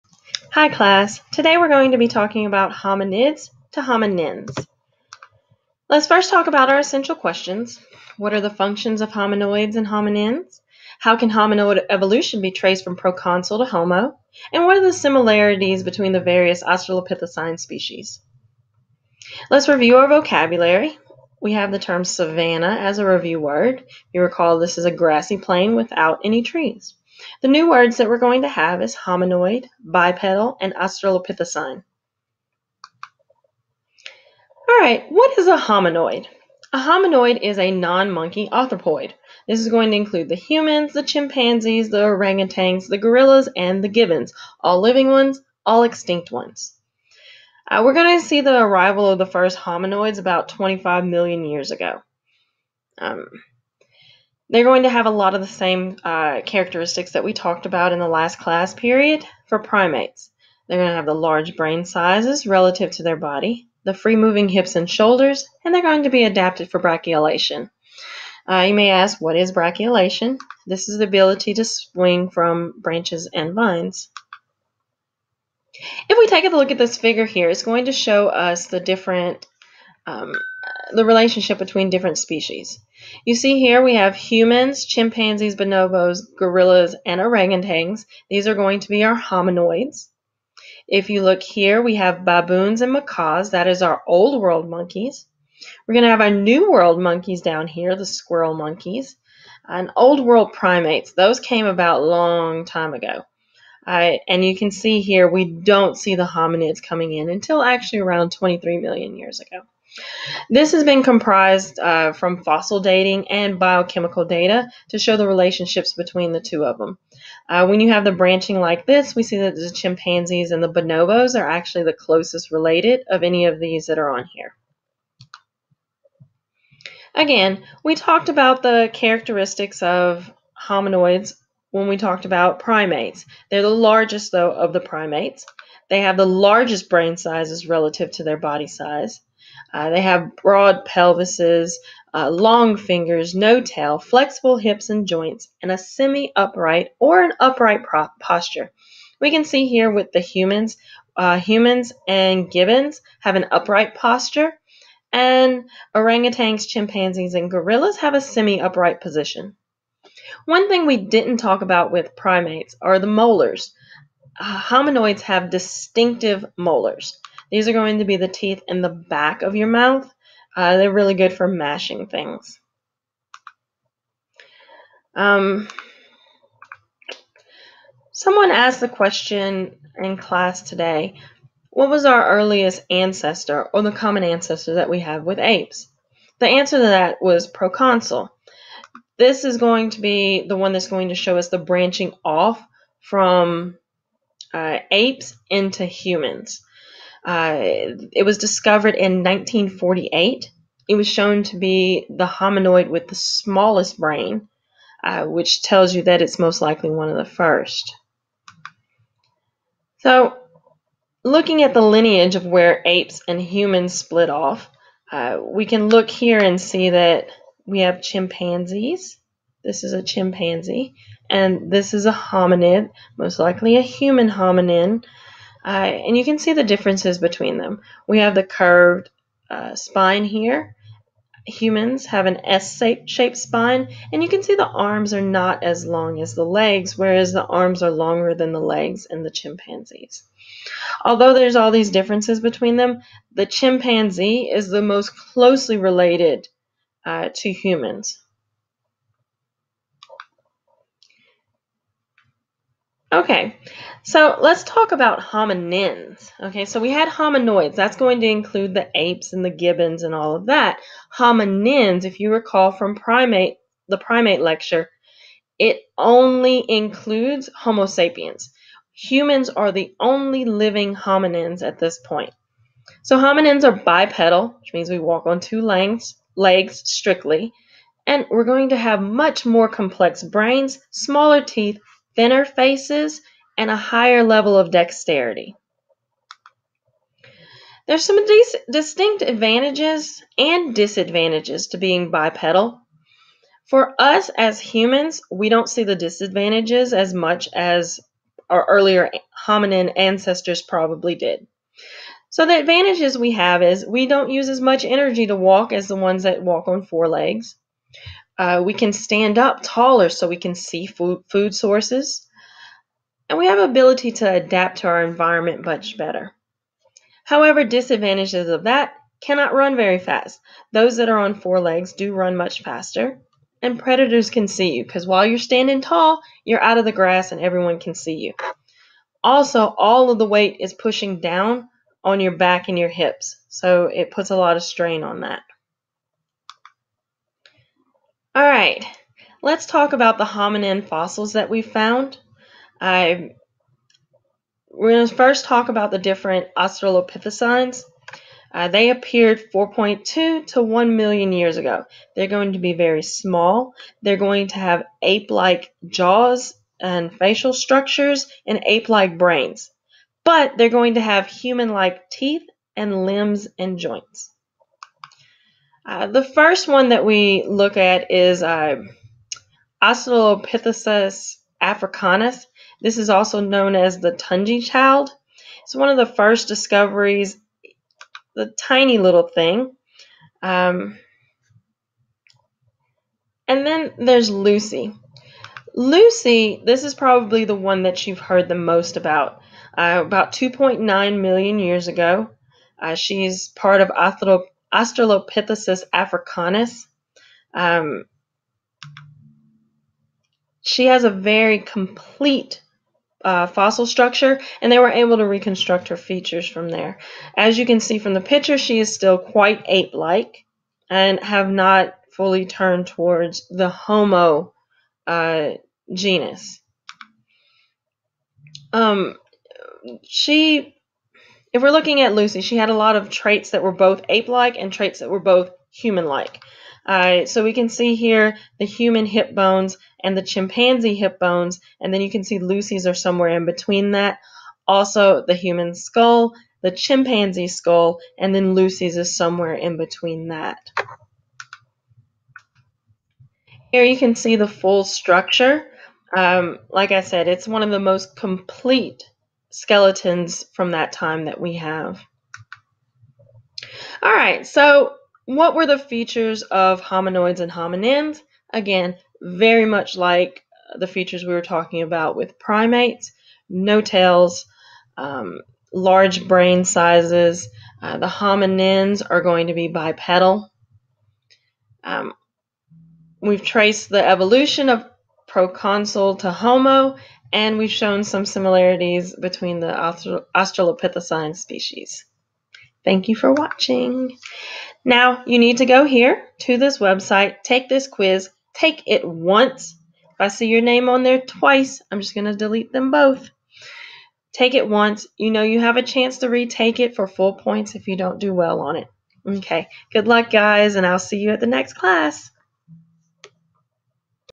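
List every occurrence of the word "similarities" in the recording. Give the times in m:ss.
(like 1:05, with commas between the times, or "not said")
0:14, 7:58.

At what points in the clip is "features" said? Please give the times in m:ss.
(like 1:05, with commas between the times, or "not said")
6:45, 7:35, 7:40.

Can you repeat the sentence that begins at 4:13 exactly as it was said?
Okay, so let's talk about hominins.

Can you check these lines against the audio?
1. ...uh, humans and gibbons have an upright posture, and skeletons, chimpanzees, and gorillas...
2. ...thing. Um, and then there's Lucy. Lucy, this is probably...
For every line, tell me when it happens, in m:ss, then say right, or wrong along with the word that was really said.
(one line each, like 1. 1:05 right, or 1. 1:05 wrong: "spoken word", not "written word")
1. 2:31 wrong: "orangutans", not "skeletons"
2. 6:19 right.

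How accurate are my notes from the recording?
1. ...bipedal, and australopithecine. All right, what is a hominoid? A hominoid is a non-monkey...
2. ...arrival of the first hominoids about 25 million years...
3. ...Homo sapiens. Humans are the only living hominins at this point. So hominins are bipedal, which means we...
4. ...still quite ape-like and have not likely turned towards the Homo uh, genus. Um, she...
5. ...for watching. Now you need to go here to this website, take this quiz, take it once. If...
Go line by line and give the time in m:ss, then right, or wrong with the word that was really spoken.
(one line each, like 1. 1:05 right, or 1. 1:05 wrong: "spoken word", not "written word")
1. 0:29 right
2. 0:48 right
3. 4:27 right
4. 6:48 wrong: "fully", not "likely"
5. 8:03 right.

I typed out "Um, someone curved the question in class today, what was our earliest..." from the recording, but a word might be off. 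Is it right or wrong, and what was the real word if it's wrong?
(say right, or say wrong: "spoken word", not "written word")
wrong: "asked", not "curved".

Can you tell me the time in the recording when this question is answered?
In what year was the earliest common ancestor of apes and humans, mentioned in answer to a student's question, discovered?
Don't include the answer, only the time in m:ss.
3:19.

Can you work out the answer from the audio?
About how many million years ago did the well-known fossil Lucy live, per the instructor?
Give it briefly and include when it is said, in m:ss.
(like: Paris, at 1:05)
2.9 million years ago, at 6:30.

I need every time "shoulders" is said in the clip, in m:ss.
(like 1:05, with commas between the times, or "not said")
1:04.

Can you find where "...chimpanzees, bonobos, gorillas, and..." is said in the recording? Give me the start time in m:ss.
1:24.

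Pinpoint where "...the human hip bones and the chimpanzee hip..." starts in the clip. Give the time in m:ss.
7:08.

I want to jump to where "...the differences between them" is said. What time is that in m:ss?
3:46.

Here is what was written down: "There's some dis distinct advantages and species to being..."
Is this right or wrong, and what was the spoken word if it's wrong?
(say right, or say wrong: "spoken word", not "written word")
wrong: "disadvantages", not "species".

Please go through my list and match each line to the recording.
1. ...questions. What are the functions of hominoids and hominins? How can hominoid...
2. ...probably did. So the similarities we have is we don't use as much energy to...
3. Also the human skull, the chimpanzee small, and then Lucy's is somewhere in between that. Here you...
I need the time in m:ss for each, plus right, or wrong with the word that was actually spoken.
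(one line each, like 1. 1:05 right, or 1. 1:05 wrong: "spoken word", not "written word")
1. 0:07 right
2. 5:00 wrong: "advantages", not "similarities"
3. 7:14 wrong: "skull", not "small".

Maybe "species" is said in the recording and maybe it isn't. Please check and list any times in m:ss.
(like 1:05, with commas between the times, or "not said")
0:17, 1:22, 8:01.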